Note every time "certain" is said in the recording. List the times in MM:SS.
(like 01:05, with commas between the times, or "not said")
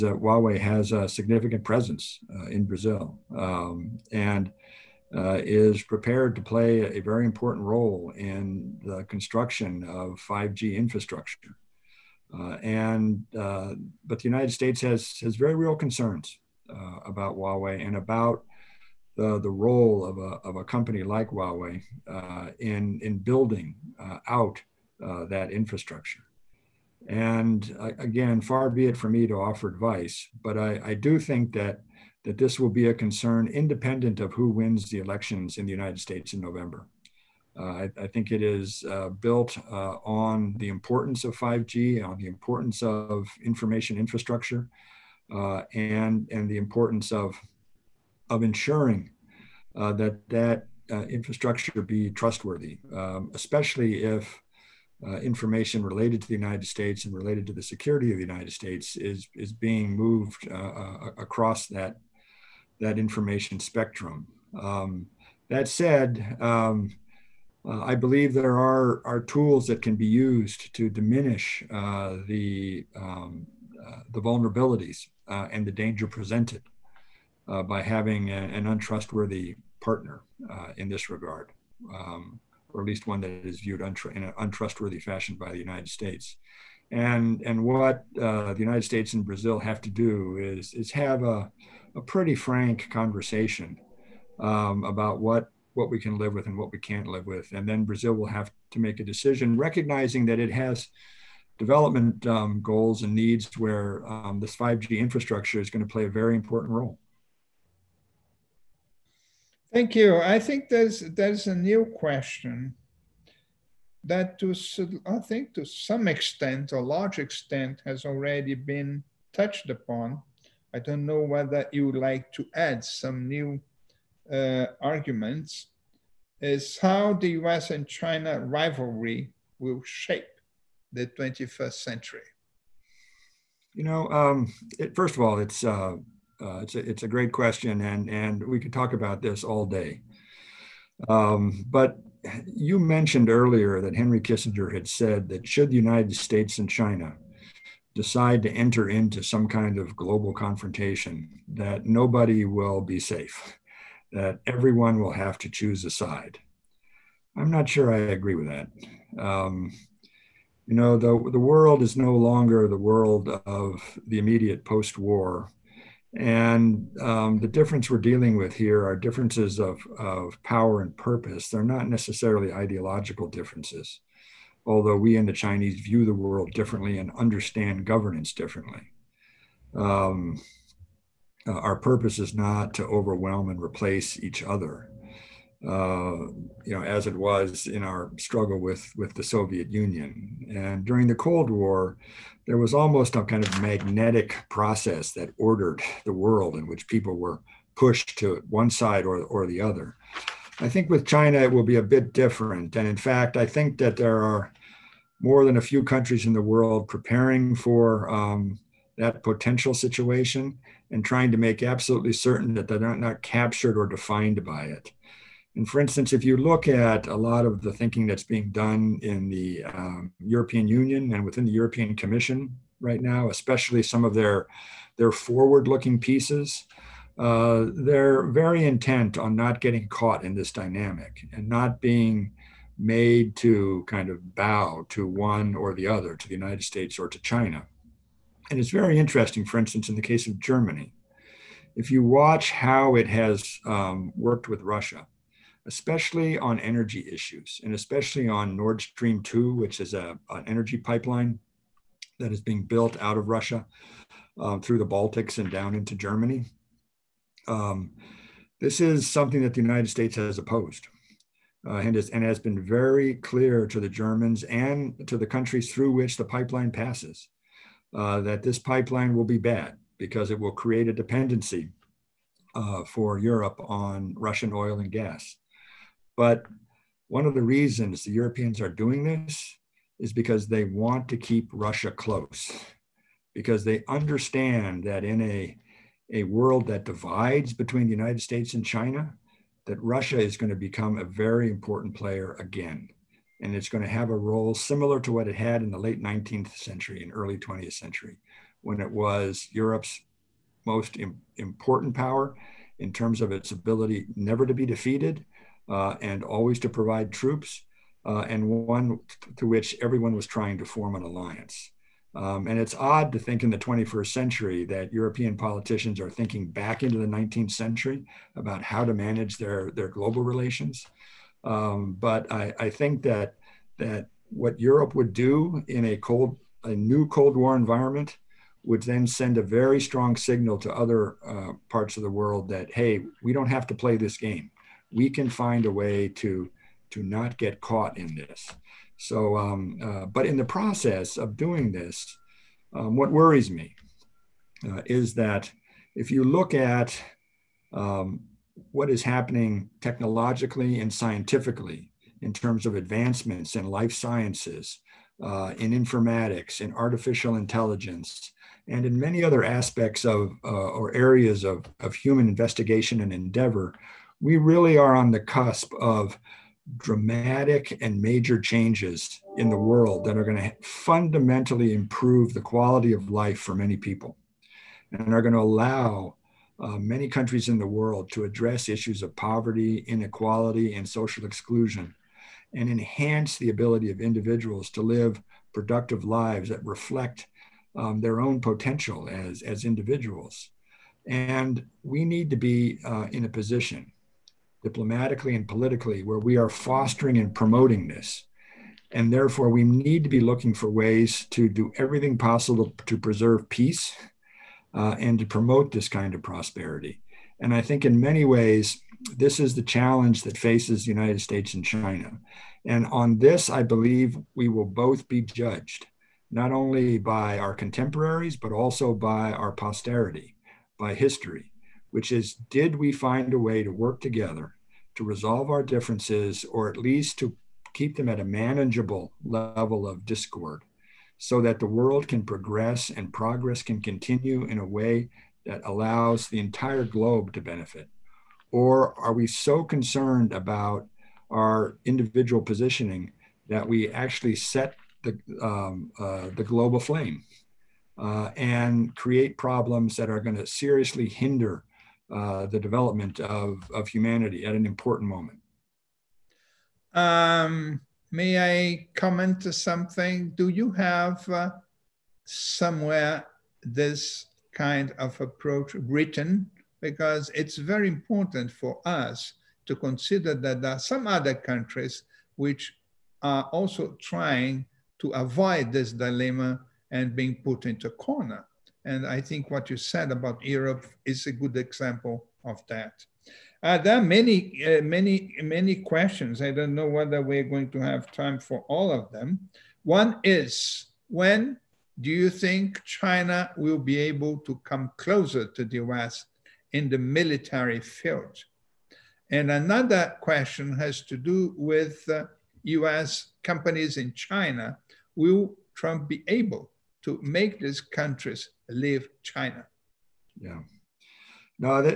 03:32.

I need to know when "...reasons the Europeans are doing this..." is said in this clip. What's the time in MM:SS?
04:37.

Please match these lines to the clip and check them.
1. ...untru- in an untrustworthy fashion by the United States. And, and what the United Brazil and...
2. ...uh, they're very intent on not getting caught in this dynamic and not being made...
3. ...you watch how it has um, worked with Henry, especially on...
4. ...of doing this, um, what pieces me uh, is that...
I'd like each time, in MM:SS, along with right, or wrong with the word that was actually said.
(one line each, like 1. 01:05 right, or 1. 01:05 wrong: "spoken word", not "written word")
1. 01:23 wrong: "States", not "Brazil"
2. 03:47 right
3. 04:01 wrong: "Russia", not "Henry"
4. 05:41 wrong: "worries", not "pieces".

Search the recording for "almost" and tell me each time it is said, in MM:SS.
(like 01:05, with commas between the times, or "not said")
03:12.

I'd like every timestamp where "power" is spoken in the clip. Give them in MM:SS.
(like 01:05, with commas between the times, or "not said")
02:50, 05:01.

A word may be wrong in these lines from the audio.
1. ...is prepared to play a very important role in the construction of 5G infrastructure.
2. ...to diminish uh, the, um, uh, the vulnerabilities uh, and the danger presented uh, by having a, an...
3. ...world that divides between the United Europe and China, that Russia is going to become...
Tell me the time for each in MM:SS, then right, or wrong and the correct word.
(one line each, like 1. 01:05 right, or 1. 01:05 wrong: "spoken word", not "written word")
1. 00:05 right
2. 01:10 right
3. 04:46 wrong: "States", not "Europe".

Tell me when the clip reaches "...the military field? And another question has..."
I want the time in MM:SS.
08:16.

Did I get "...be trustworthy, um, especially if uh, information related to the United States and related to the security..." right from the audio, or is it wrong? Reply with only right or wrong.
right.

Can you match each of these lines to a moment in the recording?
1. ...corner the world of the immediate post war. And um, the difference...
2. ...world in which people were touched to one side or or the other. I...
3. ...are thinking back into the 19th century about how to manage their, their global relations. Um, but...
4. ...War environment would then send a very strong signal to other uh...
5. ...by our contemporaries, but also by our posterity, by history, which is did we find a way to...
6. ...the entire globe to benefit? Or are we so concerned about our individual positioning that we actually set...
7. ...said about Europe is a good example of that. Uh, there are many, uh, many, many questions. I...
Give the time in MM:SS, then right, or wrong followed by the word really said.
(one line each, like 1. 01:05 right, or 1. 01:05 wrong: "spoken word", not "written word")
1. 02:42 wrong: "longer", not "corner"
2. 03:16 wrong: "pushed", not "touched"
3. 05:15 right
4. 05:27 right
5. 06:56 right
6. 07:16 right
7. 07:59 right.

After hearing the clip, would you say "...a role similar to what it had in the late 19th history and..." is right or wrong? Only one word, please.
wrong.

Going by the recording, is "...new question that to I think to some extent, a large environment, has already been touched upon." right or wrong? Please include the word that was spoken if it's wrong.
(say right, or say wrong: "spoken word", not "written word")
wrong: "extent", not "environment".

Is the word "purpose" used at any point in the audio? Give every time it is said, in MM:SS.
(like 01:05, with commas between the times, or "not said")
02:50, 03:01.